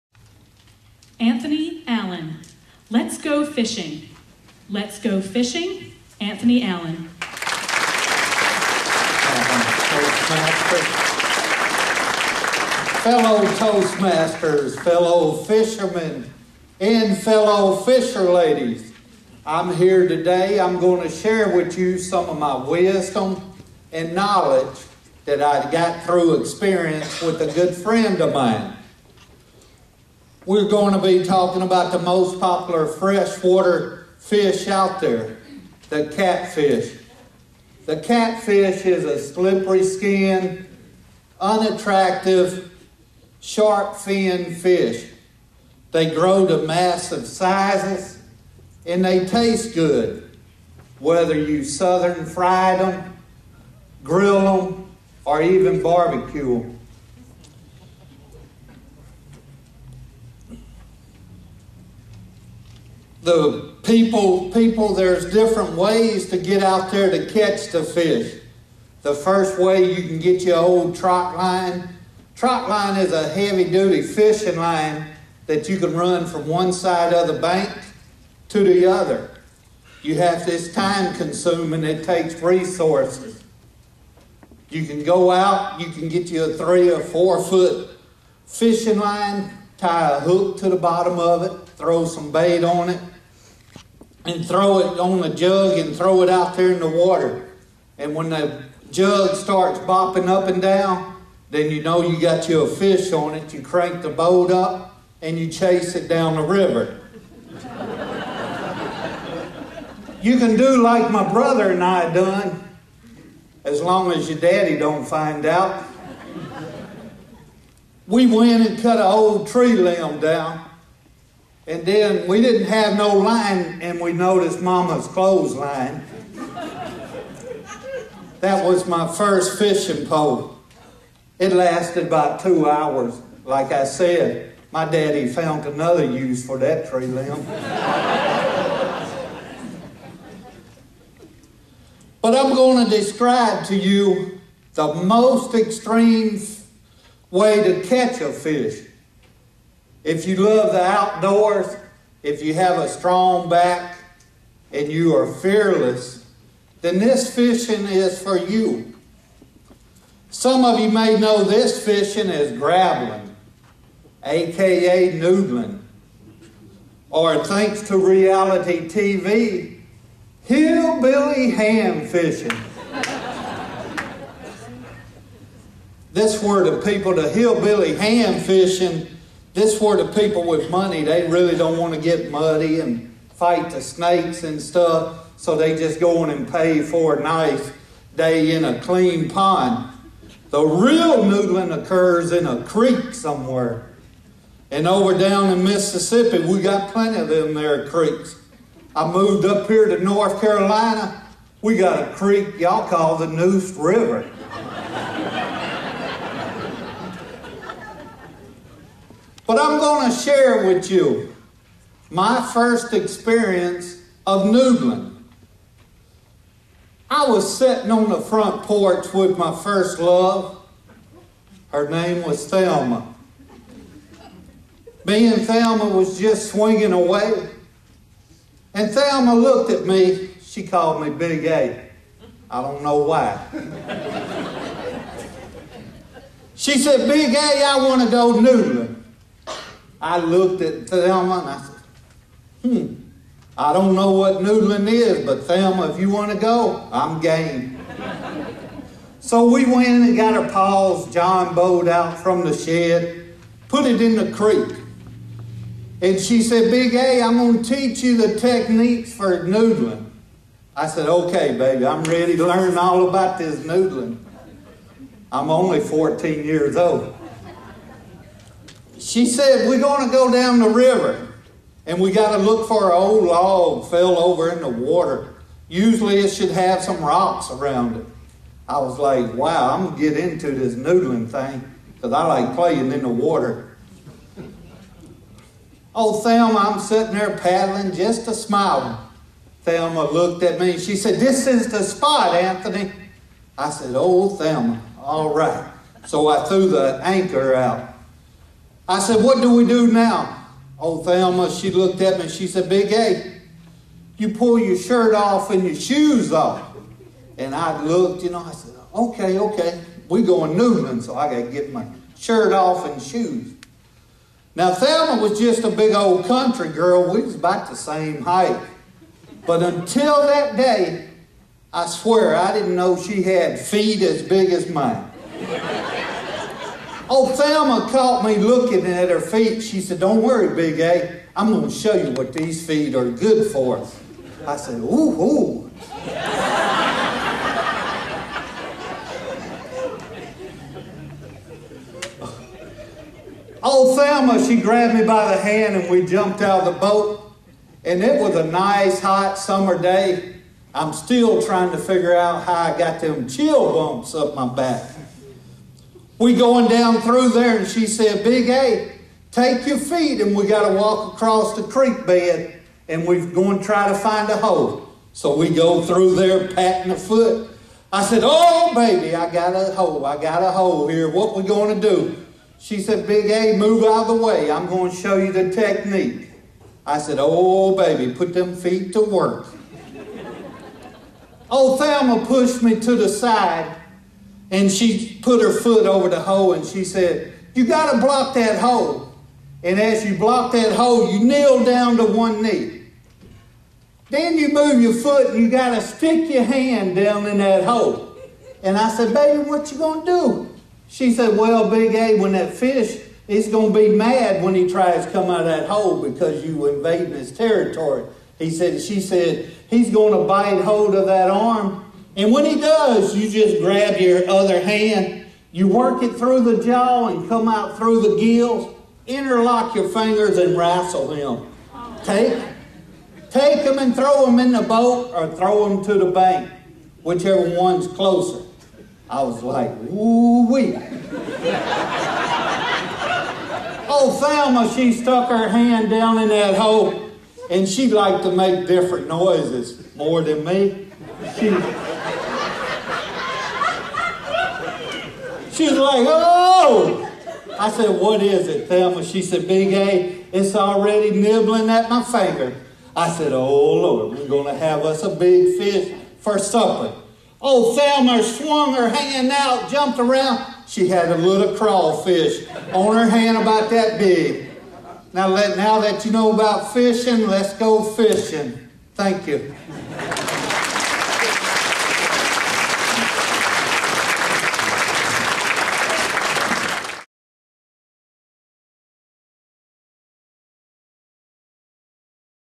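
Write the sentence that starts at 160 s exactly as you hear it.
Some of you may know this fishing as grabbling, aka noodling.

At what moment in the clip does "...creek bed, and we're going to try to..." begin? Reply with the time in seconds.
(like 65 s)
361 s.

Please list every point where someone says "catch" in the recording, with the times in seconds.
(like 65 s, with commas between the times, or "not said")
67 s, 147 s.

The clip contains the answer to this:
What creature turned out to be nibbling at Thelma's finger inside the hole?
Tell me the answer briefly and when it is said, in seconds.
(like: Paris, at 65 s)
crawfish, at 461 s.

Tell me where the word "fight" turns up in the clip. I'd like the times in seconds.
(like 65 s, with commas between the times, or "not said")
183 s.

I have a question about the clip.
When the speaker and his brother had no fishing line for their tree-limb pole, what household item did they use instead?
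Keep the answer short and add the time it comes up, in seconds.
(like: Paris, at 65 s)
Mama's clothesline, at 124 s.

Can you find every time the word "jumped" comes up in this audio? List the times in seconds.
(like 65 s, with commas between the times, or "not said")
346 s, 459 s.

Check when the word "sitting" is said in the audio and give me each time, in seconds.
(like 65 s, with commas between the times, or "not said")
217 s, 286 s.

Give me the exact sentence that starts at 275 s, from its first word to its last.
Usually it should have some rocks around it.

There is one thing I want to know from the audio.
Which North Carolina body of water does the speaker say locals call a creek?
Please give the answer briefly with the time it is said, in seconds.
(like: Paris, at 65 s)
Neuse River, at 203 s.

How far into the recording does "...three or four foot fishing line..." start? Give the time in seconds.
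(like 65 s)
86 s.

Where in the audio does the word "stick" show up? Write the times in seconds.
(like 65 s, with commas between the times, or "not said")
395 s.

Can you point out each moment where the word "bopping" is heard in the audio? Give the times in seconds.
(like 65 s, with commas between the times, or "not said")
99 s.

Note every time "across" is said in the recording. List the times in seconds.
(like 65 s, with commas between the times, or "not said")
361 s.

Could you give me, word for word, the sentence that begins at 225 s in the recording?
Me and Thelma was just swinging away.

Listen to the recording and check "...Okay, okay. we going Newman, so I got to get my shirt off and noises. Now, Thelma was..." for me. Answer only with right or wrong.
wrong.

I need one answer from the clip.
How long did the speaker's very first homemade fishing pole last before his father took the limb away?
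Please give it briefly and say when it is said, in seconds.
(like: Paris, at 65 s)
about two hours, at 132 s.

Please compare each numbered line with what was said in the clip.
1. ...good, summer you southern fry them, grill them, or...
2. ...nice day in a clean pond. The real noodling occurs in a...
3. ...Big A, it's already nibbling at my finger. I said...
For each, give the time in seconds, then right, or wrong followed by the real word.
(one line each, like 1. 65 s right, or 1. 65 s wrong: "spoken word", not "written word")
1. 49 s wrong: "whether", not "summer"
2. 187 s right
3. 449 s right.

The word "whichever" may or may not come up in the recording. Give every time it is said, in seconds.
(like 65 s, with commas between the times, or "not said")
427 s.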